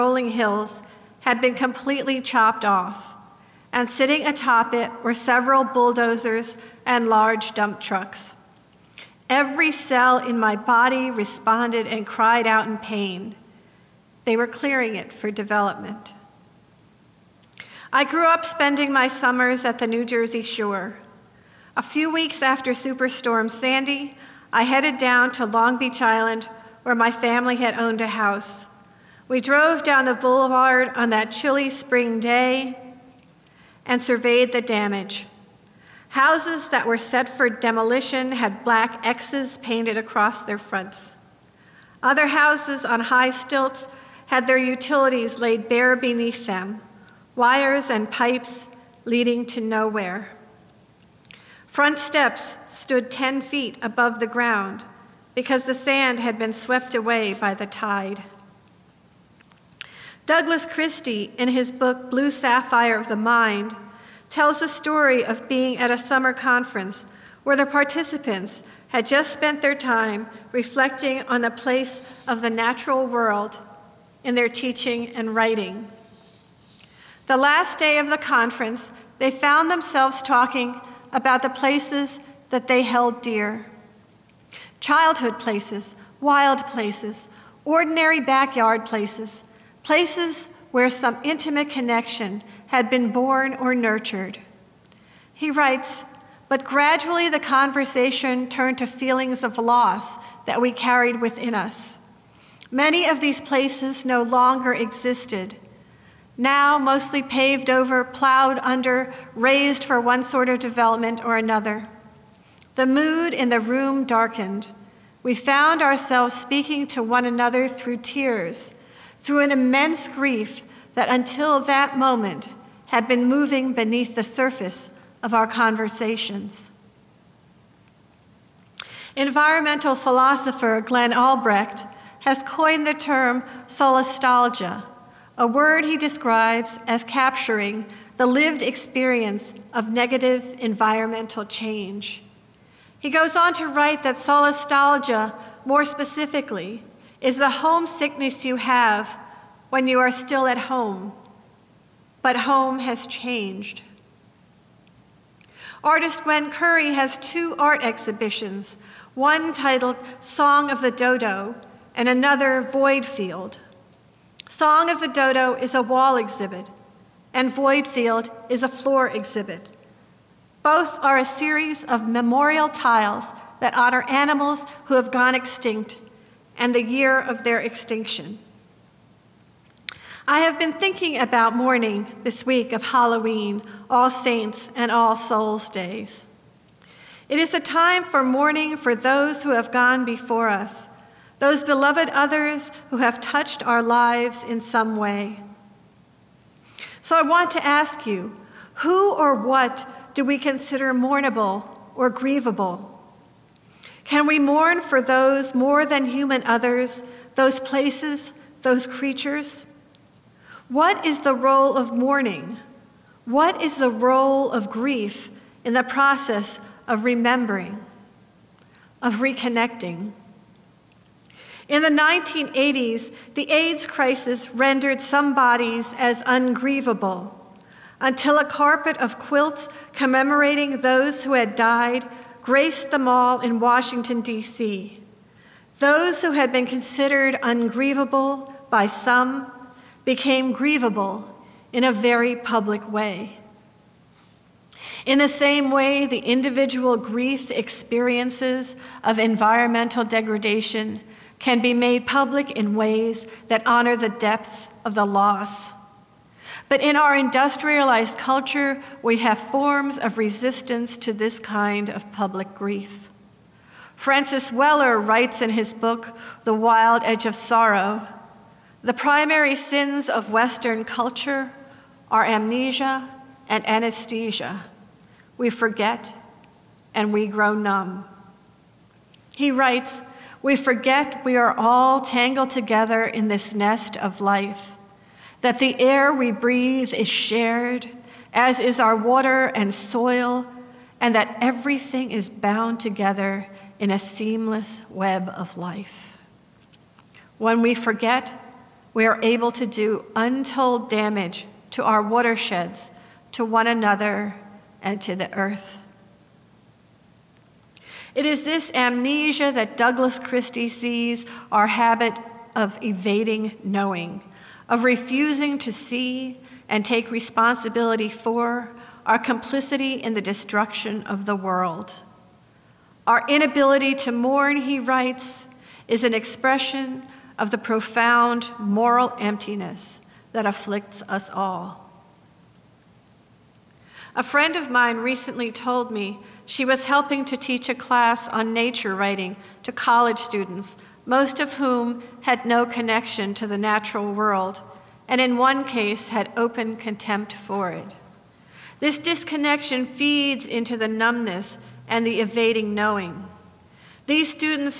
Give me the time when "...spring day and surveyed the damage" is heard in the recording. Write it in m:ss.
0:31.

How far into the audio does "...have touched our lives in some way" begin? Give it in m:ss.
3:12.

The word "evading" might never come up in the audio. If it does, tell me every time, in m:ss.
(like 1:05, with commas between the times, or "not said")
5:12, 5:52.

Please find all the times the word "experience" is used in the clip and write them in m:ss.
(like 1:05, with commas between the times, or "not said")
2:18, 4:07.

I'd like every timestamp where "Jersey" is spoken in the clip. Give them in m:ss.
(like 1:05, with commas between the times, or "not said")
0:20.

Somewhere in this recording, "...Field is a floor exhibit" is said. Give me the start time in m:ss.
2:47.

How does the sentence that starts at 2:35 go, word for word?
Artist Gwen Curry has two art exhibitions, one titled Song of the Dodo and another Void Field.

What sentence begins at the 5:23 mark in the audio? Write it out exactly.
Our inability to mourn, he writes, is an expression of the profound moral emptiness that afflicts us all.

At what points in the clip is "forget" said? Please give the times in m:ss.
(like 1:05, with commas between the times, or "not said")
4:35, 4:40, 4:57.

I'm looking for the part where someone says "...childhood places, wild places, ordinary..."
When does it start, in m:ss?
1:24.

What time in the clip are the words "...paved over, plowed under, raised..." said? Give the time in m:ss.
1:47.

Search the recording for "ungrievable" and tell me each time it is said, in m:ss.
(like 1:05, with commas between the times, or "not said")
3:46, 3:57.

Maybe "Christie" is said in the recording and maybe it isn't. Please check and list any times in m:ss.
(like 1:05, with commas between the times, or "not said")
1:00, 5:10.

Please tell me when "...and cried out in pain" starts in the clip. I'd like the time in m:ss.
0:11.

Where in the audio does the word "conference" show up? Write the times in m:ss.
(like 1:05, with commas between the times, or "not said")
1:06, 1:18.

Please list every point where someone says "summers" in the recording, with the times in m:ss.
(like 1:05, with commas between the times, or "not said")
0:19, 1:05.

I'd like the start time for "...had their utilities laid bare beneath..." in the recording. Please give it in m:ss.
0:44.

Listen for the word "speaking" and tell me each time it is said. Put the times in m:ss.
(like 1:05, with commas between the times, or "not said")
1:56.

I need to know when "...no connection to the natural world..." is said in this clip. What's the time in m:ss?
5:42.